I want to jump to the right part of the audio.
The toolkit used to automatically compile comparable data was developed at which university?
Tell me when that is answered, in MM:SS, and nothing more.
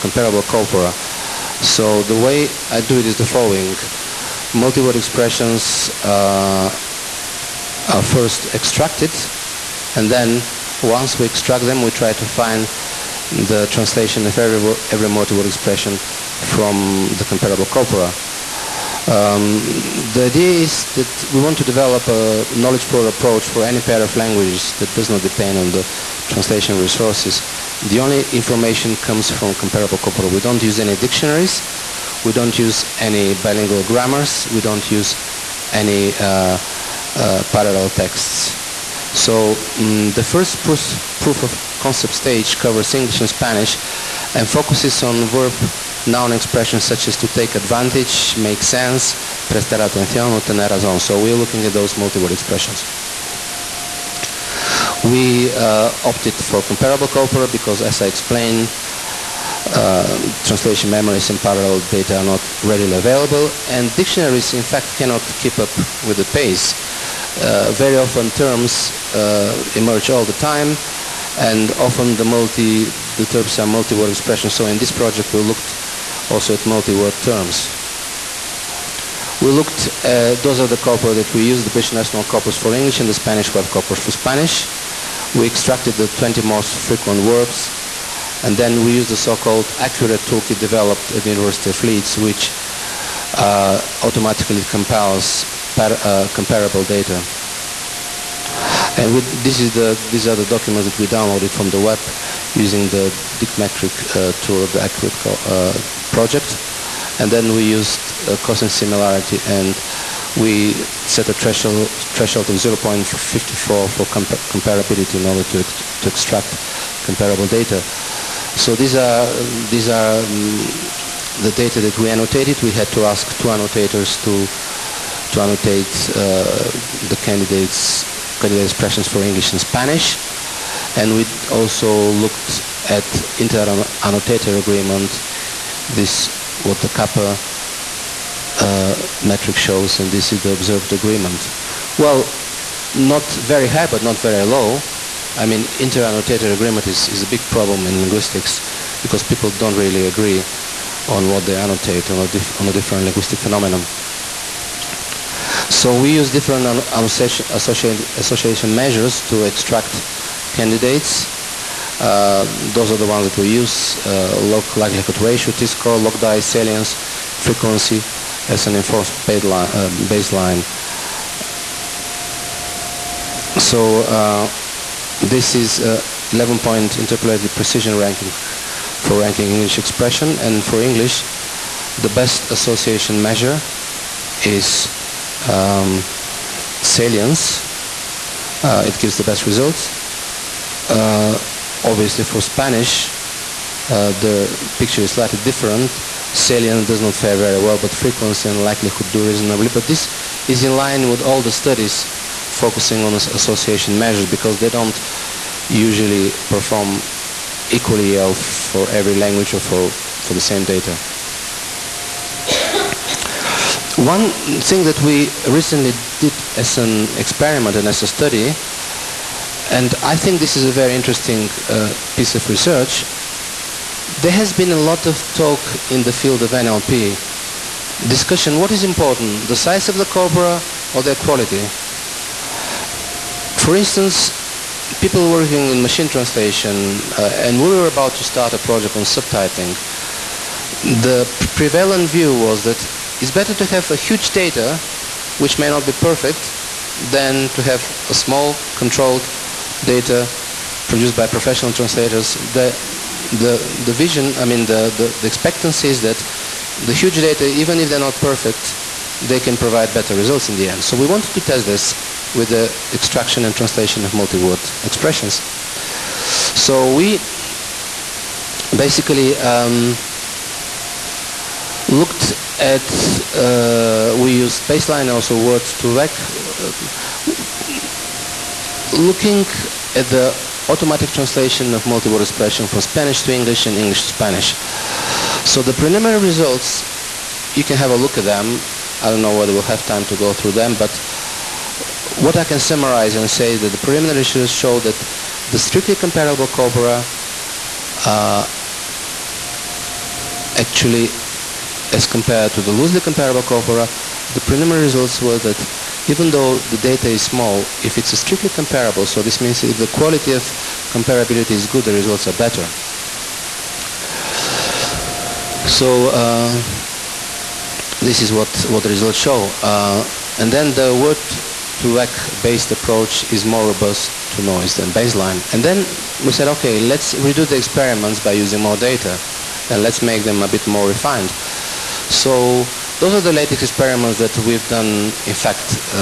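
01:31.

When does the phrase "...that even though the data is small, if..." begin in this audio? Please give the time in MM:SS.
05:05.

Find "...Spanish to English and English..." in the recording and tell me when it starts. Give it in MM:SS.
04:42.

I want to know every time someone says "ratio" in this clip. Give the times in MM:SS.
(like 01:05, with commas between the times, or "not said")
02:45.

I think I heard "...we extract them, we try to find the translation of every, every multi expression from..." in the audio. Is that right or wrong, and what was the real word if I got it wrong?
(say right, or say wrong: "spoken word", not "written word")
right.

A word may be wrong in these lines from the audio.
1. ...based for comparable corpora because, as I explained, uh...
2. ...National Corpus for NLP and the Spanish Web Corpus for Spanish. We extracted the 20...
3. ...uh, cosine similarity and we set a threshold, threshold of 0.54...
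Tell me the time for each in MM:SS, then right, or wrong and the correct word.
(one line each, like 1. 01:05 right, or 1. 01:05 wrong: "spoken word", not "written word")
1. 00:56 wrong: "opted", not "based"
2. 01:21 wrong: "English", not "NLP"
3. 01:48 right.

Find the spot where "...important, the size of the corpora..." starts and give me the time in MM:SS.
03:48.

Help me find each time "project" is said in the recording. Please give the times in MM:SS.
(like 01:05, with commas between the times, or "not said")
01:14, 01:46, 03:58.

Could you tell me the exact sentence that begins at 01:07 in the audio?
Uh, very often, terms uh, emerge all the time, and often the multi the terms are multi-word expressions.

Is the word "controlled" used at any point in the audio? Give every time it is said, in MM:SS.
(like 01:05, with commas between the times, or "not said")
04:08.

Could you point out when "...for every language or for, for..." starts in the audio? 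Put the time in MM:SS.
03:28.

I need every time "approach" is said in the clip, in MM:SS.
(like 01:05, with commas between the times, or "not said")
00:23, 05:22.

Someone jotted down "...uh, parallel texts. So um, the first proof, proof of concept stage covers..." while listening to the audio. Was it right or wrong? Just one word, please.
right.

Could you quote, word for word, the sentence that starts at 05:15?
So uh, this is what, what the results show.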